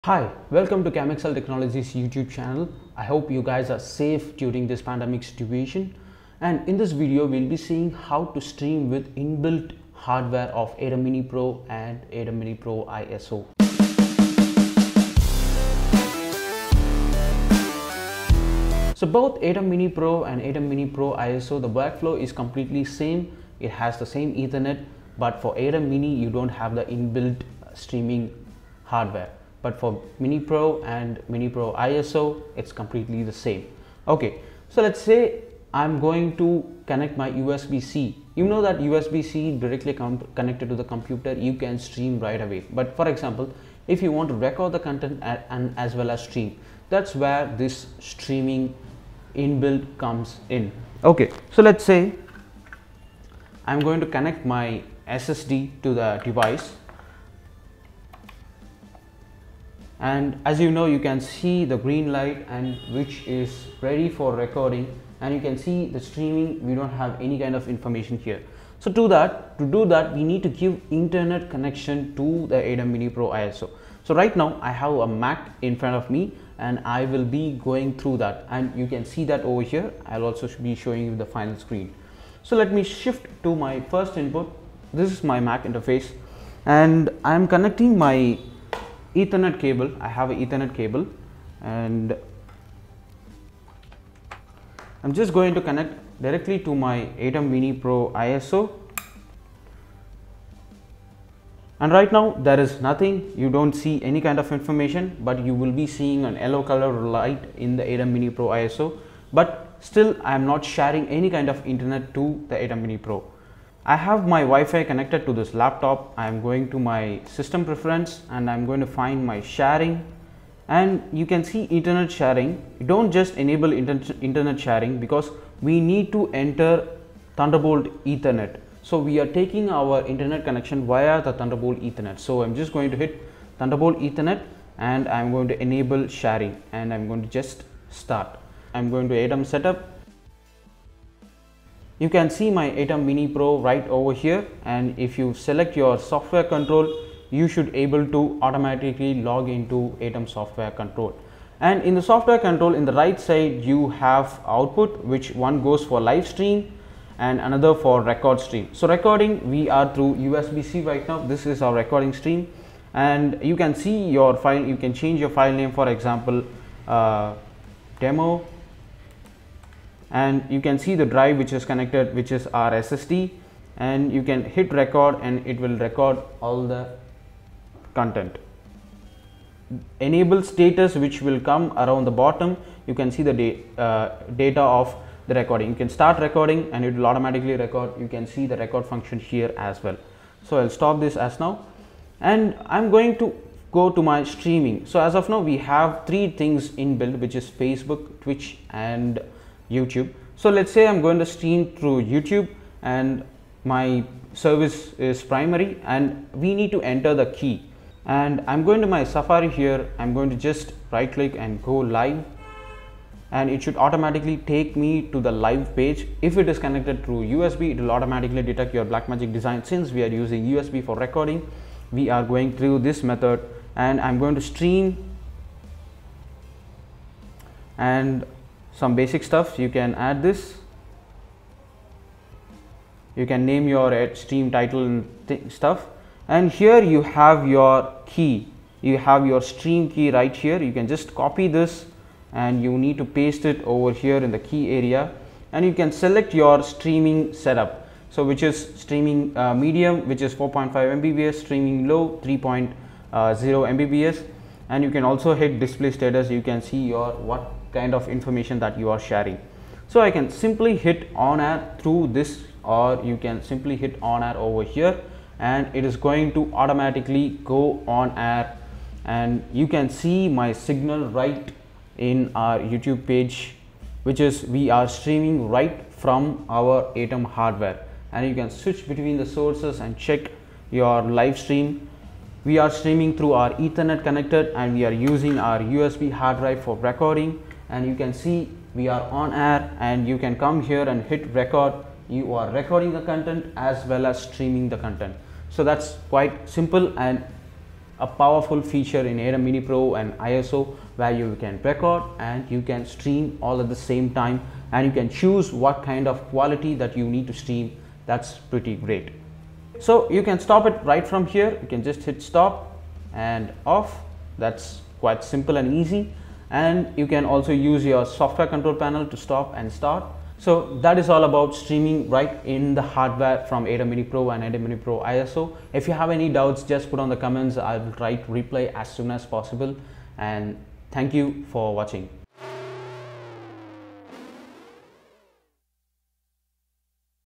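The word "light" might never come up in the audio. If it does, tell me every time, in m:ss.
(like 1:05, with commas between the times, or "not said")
1:02, 1:47.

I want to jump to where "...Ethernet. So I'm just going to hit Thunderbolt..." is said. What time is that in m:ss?
2:11.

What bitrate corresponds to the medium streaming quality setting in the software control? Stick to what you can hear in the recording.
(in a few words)
4.5 Mbps.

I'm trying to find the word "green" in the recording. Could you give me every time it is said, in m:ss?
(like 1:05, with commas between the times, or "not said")
1:01.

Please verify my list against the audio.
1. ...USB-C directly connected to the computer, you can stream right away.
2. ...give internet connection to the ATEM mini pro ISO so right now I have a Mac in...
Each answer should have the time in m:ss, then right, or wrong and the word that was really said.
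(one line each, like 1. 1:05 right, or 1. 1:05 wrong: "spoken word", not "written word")
1. 0:38 right
2. 1:10 right.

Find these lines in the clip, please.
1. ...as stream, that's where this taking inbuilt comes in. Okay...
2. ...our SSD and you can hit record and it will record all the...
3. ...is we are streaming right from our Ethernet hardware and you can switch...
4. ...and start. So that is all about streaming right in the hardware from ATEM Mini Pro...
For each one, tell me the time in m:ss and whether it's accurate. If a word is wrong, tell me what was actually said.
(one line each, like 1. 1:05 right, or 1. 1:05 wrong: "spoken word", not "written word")
1. 0:46 wrong: "streaming", not "taking"
2. 2:52 right
3. 4:34 wrong: "ATEM", not "Ethernet"
4. 5:19 right.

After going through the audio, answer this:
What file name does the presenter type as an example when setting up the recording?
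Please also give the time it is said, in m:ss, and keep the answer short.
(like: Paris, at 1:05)
demo, at 2:47.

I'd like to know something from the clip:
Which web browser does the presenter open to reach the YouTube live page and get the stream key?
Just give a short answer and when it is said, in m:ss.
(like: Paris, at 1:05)
Safari, at 3:29.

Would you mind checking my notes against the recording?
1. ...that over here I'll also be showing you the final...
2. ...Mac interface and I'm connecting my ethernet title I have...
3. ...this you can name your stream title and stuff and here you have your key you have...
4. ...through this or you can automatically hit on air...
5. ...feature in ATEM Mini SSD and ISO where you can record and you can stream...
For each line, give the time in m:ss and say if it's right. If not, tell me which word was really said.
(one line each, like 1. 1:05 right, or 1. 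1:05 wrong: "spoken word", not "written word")
1. 1:19 right
2. 1:25 wrong: "cable", not "title"
3. 3:50 right
4. 4:21 wrong: "simply", not "automatically"
5. 4:58 wrong: "Pro", not "SSD".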